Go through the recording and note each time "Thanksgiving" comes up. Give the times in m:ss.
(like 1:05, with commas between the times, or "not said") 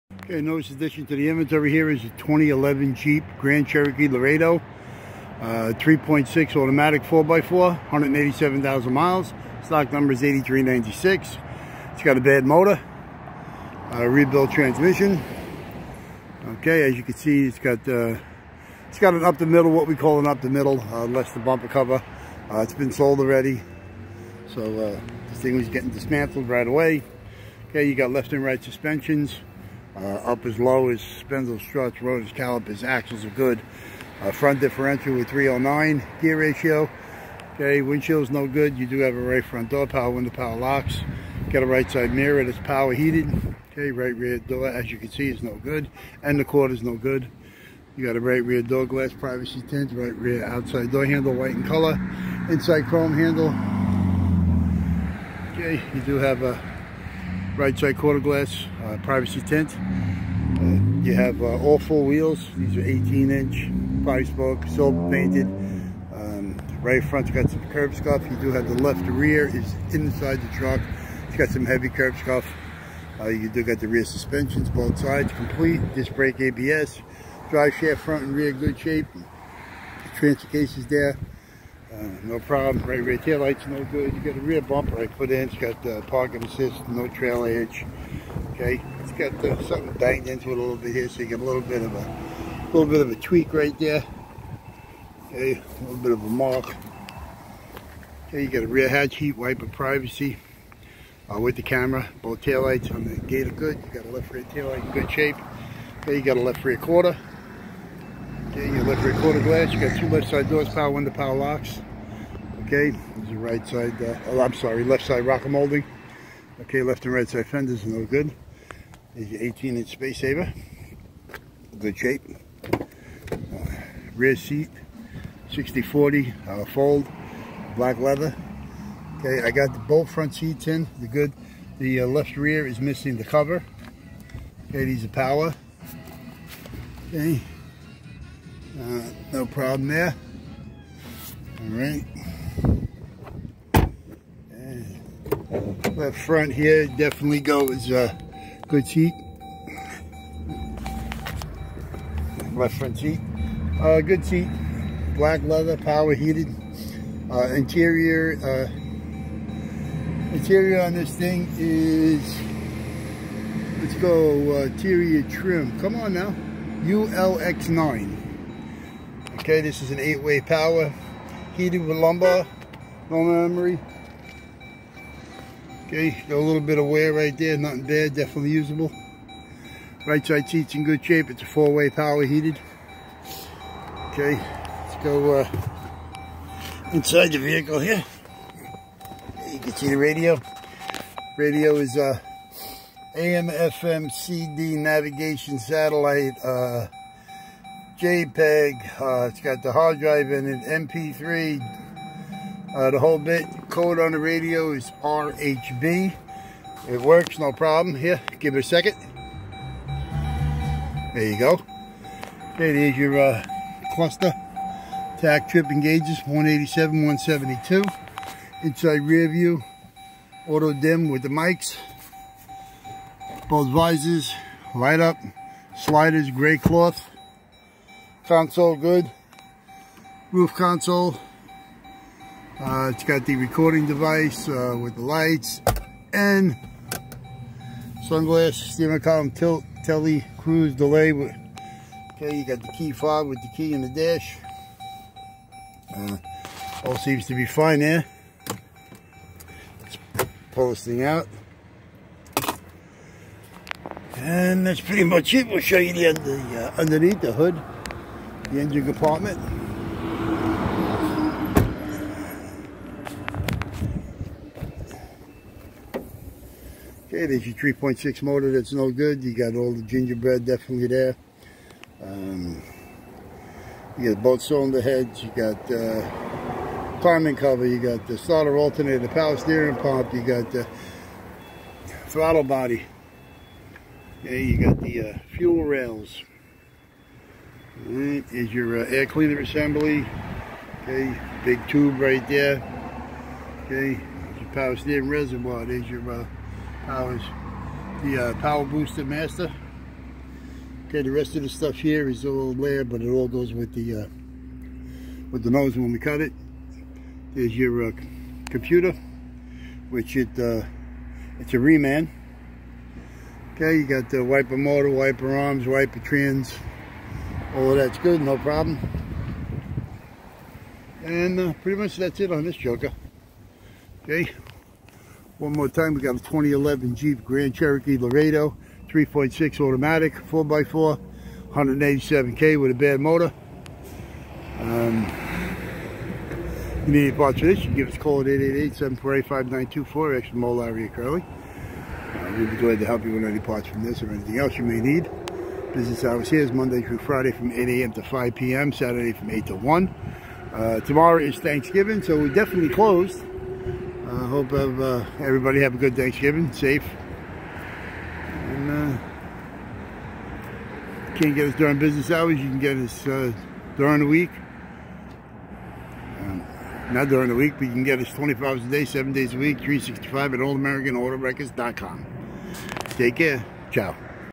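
5:51, 5:55.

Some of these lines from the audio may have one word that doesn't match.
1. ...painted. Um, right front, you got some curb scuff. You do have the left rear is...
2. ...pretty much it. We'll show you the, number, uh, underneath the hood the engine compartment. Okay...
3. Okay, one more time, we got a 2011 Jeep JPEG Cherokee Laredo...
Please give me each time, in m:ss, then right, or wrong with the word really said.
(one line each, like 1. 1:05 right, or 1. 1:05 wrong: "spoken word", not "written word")
1. 1:05 right
2. 4:14 wrong: "under", not "number"
3. 5:24 wrong: "Grand", not "JPEG".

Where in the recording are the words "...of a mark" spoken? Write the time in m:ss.
1:36.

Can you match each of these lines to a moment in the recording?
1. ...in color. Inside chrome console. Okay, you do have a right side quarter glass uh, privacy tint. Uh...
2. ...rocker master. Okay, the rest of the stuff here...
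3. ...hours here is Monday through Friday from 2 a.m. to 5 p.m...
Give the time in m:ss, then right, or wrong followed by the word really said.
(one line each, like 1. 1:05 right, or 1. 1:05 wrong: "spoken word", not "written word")
1. 0:51 wrong: "handle", not "console"
2. 4:58 wrong: "booster", not "rocker"
3. 5:46 wrong: "8", not "2".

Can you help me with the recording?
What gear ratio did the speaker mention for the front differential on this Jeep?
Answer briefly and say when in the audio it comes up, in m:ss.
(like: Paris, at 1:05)
3.09, at 0:35.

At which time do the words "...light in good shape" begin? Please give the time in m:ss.
1:44.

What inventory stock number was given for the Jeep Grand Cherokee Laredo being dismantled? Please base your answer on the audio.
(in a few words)
8396.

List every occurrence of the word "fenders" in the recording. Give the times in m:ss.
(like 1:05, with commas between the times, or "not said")
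1:57.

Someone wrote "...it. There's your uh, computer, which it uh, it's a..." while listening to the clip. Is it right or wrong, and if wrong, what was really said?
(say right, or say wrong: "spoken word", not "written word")
right.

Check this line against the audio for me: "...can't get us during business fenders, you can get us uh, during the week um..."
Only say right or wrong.
wrong.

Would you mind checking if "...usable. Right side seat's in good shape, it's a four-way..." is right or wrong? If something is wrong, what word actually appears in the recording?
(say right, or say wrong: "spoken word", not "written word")
right.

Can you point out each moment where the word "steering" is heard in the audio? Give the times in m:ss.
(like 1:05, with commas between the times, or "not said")
4:39, 4:54.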